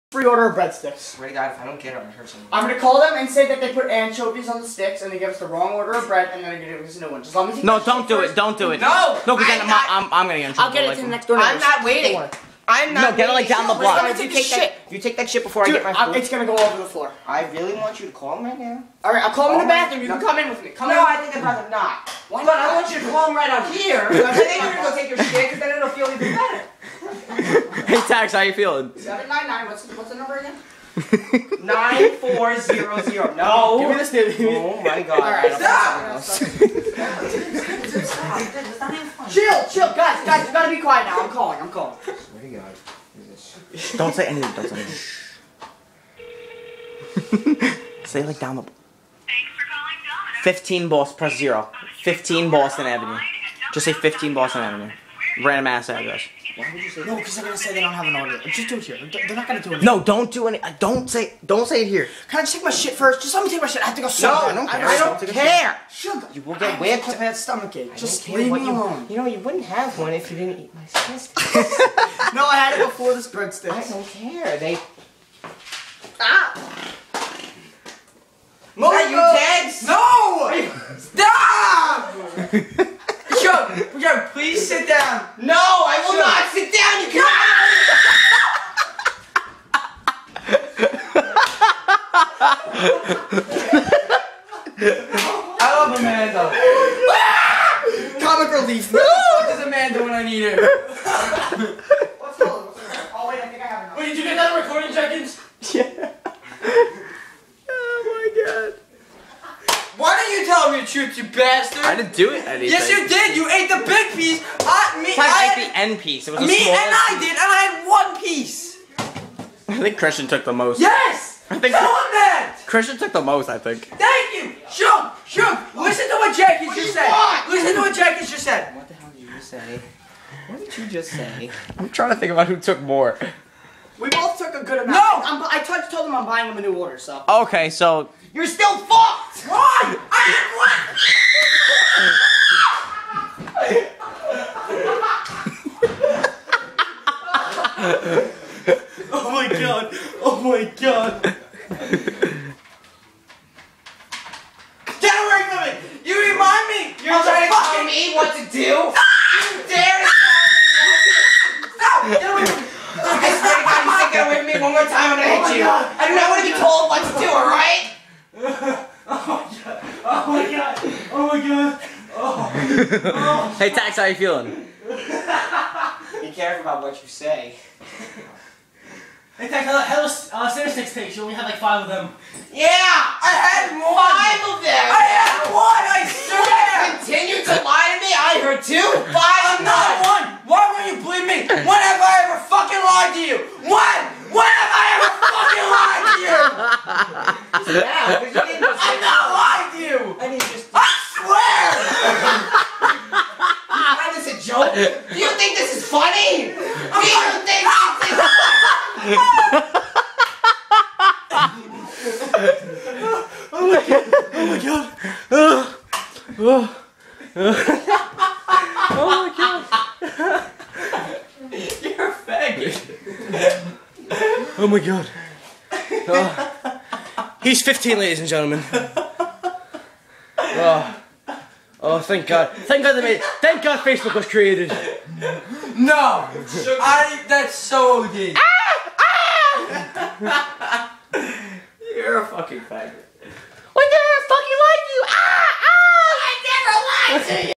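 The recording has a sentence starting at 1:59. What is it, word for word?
I think Christian took the most.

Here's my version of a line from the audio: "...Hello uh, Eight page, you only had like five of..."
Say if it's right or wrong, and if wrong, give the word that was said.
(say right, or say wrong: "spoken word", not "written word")
wrong: "Six", not "Eight".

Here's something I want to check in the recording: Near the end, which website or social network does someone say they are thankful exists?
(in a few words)
Facebook.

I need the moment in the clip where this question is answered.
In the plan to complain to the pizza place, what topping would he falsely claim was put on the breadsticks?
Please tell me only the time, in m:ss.
0:03.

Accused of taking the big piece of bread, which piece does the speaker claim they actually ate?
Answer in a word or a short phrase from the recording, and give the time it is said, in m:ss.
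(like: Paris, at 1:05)
end piece, at 1:55.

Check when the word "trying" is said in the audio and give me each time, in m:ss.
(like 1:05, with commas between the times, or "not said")
2:11, 2:37.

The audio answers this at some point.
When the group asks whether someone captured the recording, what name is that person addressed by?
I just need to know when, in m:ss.
1:44.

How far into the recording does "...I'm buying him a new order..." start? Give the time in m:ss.
2:16.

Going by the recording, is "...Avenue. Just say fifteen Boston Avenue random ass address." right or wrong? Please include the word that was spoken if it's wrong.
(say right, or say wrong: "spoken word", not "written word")
right.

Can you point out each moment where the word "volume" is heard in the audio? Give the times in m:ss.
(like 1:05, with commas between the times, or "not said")
not said.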